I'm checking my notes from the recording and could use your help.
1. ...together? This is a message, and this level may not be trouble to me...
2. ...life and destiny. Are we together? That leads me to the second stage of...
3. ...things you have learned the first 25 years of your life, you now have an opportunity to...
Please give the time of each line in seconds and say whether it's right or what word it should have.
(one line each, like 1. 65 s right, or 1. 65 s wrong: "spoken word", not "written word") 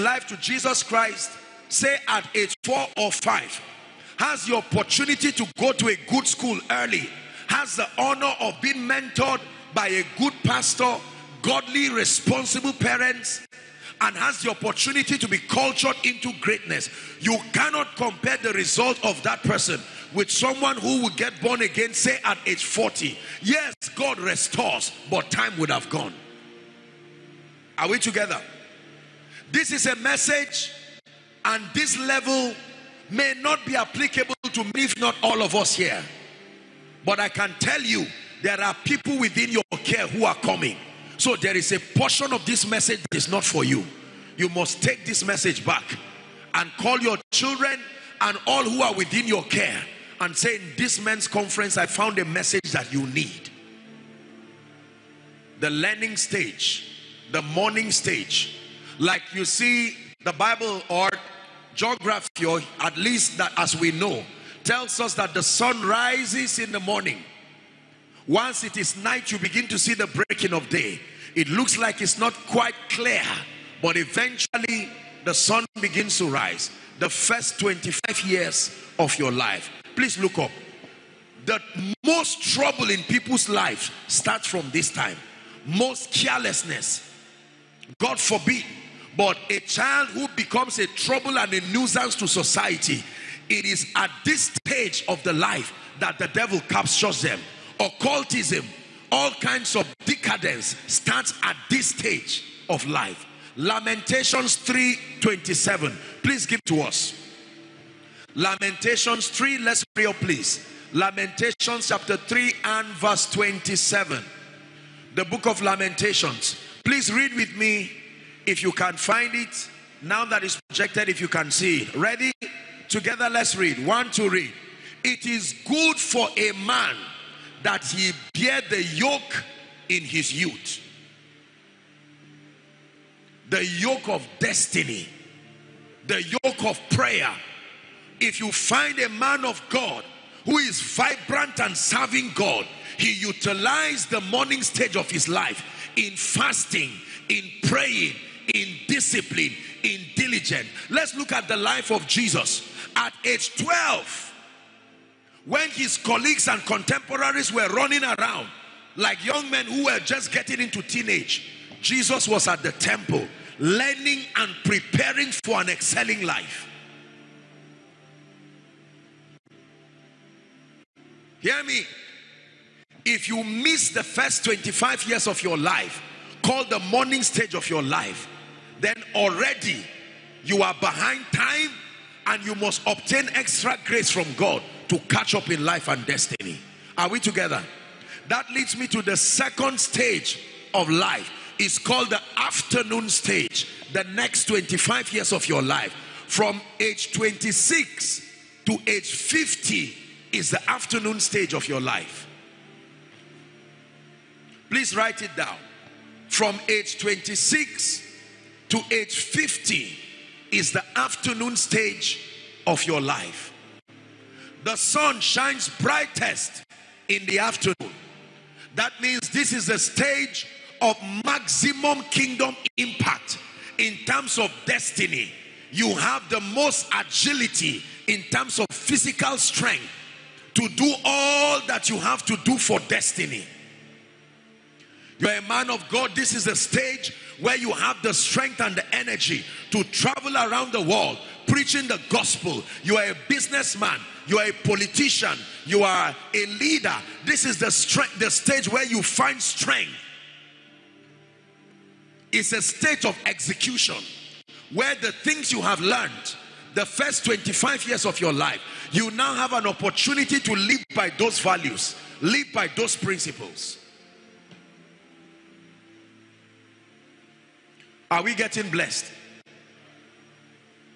1. 27 s wrong: "applicable", not "trouble"
2. 185 s right
3. 255 s right.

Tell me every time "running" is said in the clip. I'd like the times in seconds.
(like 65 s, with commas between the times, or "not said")
157 s.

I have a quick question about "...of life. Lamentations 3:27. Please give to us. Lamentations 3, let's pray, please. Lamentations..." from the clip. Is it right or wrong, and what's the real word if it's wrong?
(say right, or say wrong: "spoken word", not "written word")
right.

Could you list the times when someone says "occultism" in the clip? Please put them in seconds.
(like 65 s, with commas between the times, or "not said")
97 s.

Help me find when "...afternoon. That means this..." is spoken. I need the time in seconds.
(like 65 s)
217 s.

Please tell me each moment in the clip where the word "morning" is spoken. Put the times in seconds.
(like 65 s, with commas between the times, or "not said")
57 s, 66 s, 144 s, 176 s.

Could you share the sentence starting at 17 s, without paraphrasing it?
You cannot compare the result of that person with someone who will get born again, say at age 40.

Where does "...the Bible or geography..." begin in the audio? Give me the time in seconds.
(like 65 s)
60 s.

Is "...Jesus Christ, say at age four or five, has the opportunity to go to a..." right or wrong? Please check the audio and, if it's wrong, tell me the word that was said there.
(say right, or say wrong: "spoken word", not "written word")
right.